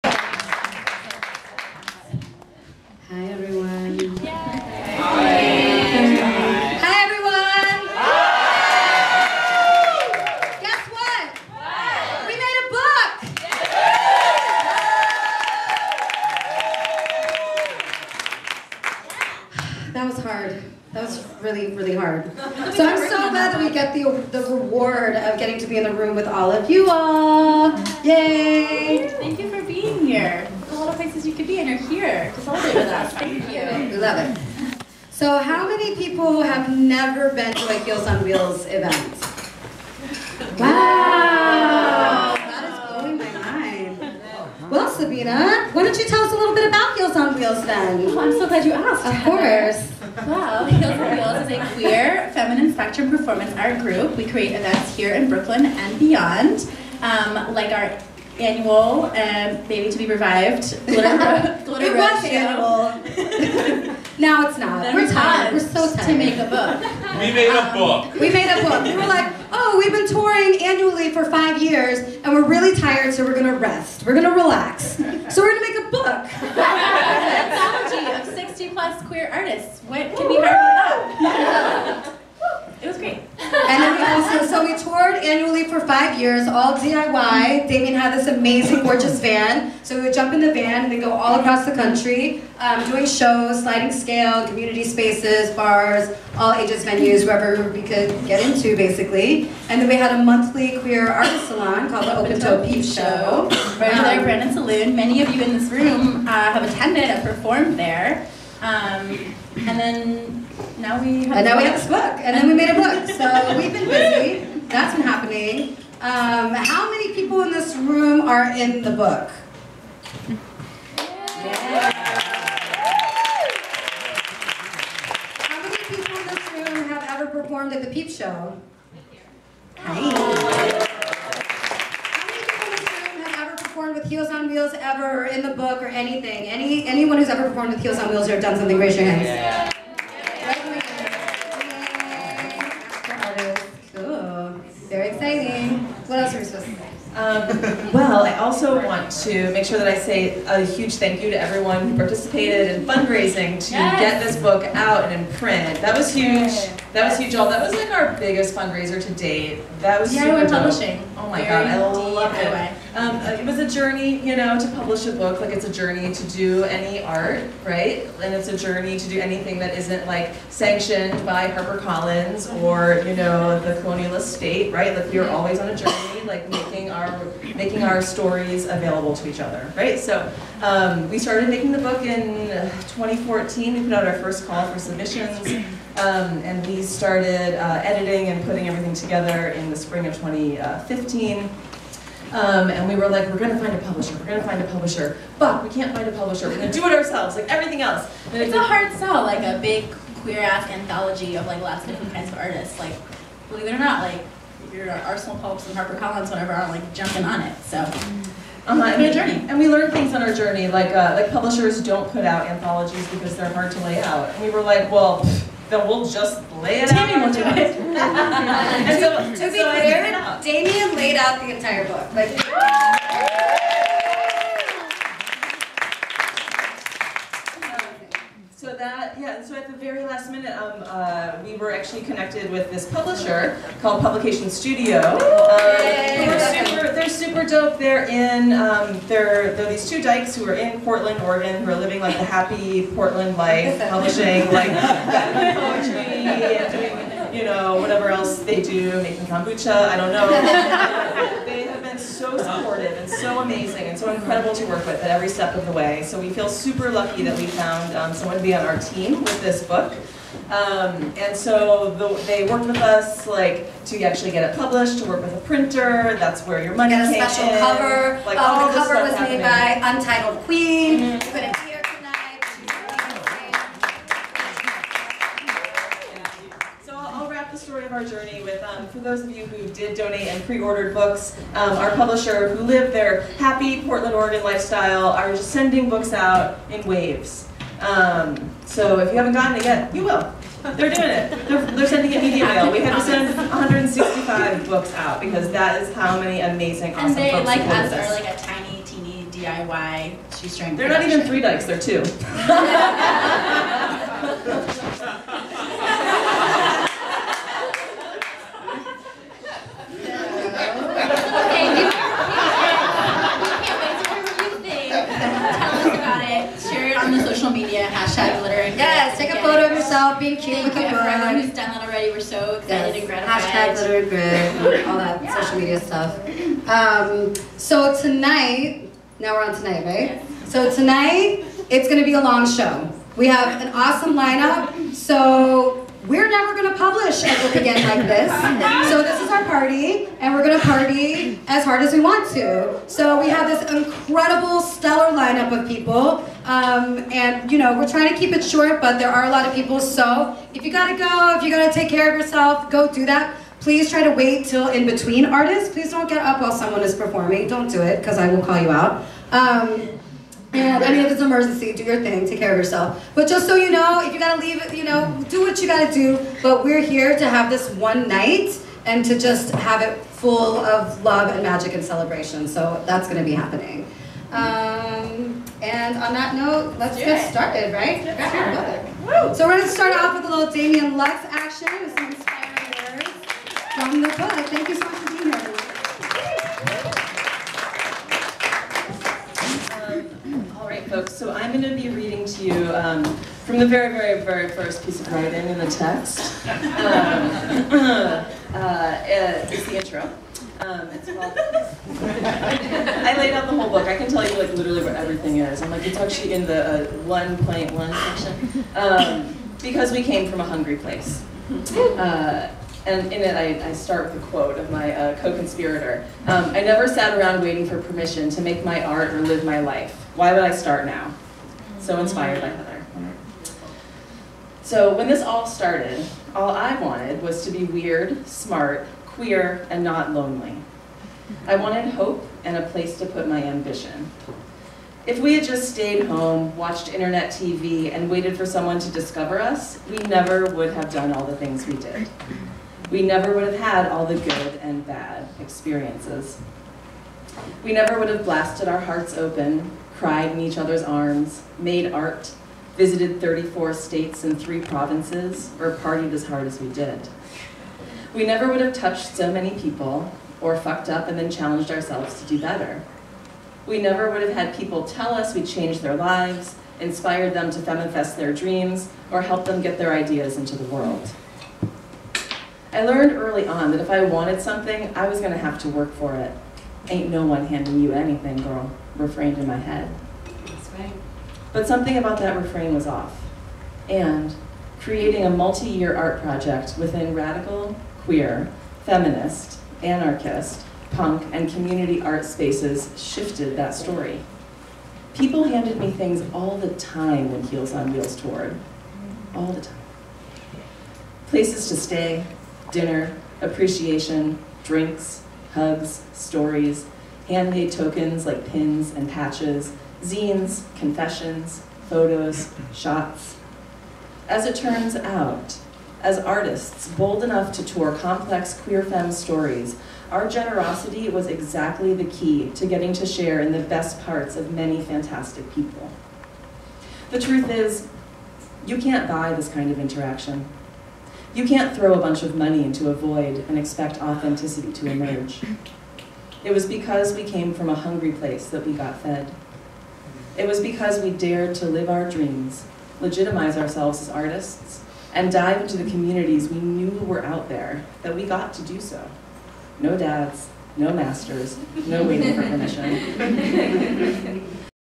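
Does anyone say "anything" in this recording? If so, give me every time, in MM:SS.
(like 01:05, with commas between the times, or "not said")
02:15, 02:49, 07:57.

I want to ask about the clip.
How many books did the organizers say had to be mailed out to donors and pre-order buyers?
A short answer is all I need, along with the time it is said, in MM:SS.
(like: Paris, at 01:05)
165, at 04:53.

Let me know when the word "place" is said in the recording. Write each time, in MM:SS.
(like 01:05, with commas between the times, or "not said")
00:30, 06:50, 07:12, 08:21, 08:58.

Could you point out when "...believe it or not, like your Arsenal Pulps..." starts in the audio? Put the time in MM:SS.
03:23.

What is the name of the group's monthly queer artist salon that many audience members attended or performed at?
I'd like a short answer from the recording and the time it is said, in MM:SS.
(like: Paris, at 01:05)
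Open Toe Peep Show, at 01:42.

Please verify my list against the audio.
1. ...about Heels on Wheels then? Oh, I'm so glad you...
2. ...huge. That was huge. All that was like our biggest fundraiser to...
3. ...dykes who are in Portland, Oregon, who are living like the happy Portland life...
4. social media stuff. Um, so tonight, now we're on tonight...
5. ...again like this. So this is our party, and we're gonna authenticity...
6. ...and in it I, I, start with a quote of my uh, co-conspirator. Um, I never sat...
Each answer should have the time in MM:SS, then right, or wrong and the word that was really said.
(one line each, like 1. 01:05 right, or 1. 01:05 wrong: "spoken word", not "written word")
1. 00:46 right
2. 02:36 right
3. 04:00 right
4. 05:25 right
5. 05:37 wrong: "party", not "authenticity"
6. 06:52 right.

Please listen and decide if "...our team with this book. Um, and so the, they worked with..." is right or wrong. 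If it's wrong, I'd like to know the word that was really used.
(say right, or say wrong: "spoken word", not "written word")
right.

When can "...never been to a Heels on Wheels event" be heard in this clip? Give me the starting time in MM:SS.
00:36.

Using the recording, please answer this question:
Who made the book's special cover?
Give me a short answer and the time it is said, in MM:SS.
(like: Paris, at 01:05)
Untitled Queen, at 04:29.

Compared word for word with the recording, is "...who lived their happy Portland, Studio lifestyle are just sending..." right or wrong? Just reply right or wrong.
wrong.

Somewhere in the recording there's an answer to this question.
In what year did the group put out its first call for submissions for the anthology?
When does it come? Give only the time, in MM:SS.
03:02.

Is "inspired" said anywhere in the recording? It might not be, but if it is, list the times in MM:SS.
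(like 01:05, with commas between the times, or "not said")
07:01, 07:46.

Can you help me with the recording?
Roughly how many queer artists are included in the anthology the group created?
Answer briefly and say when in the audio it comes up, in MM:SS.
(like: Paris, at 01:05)
60 plus, at 01:18.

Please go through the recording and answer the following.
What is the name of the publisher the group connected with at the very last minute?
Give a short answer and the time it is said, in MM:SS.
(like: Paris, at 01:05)
Publication Studio, at 03:54.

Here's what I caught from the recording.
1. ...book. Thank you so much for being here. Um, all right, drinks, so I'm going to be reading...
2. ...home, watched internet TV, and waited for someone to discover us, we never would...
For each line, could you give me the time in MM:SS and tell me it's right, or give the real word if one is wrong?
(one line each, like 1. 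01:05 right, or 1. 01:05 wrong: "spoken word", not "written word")
1. 06:24 wrong: "folks", not "drinks"
2. 07:16 right.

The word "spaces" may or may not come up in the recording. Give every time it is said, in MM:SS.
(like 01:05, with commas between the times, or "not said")
01:34, 08:12.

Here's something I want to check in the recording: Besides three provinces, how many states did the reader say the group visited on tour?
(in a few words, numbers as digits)
34.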